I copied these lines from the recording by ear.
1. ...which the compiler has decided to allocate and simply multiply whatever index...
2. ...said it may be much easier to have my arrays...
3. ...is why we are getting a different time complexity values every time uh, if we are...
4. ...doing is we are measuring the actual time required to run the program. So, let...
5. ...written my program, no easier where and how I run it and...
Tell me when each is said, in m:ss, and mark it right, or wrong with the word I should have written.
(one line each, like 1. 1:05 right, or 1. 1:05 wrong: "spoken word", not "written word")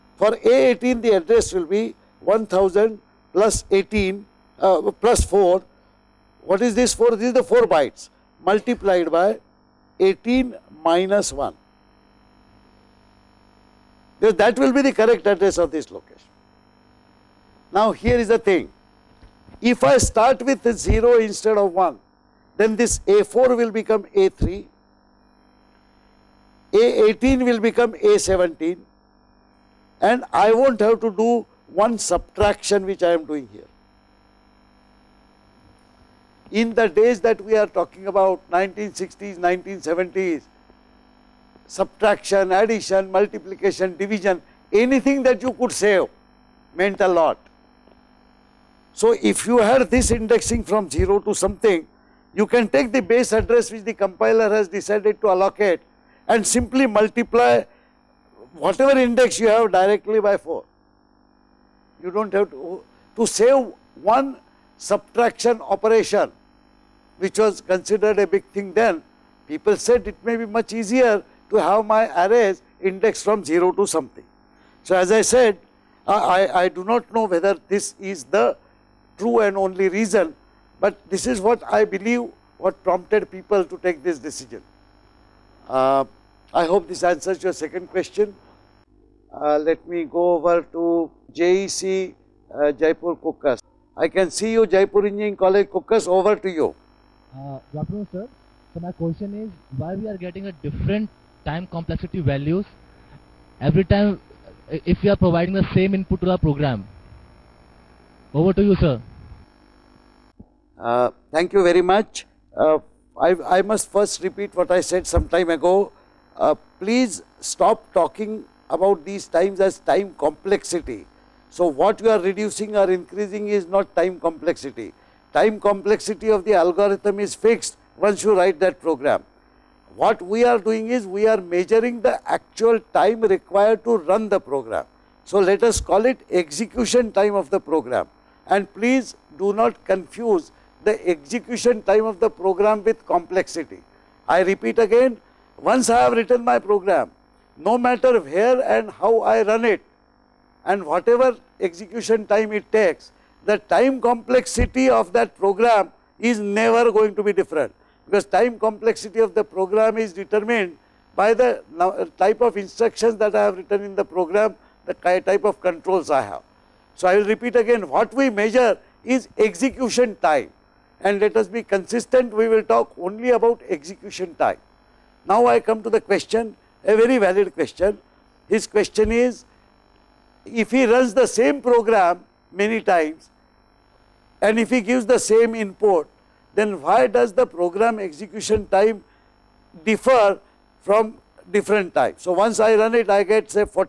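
1. 0:53 right
2. 1:09 right
3. 1:39 right
4. 2:10 right
5. 2:26 wrong: "matter", not "easier".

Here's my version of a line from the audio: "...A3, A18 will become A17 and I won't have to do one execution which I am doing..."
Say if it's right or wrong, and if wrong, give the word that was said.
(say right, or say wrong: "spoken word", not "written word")
wrong: "subtraction", not "execution".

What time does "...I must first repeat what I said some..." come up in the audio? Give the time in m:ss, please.
1:53.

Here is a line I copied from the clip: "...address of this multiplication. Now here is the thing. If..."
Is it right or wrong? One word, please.
wrong.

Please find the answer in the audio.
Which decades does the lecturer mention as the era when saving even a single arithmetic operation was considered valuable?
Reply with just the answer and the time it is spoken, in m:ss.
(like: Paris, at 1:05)
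1960s, 1970s, at 0:38.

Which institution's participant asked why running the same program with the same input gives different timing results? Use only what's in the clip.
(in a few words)
Jaipur Engineering College Kukas.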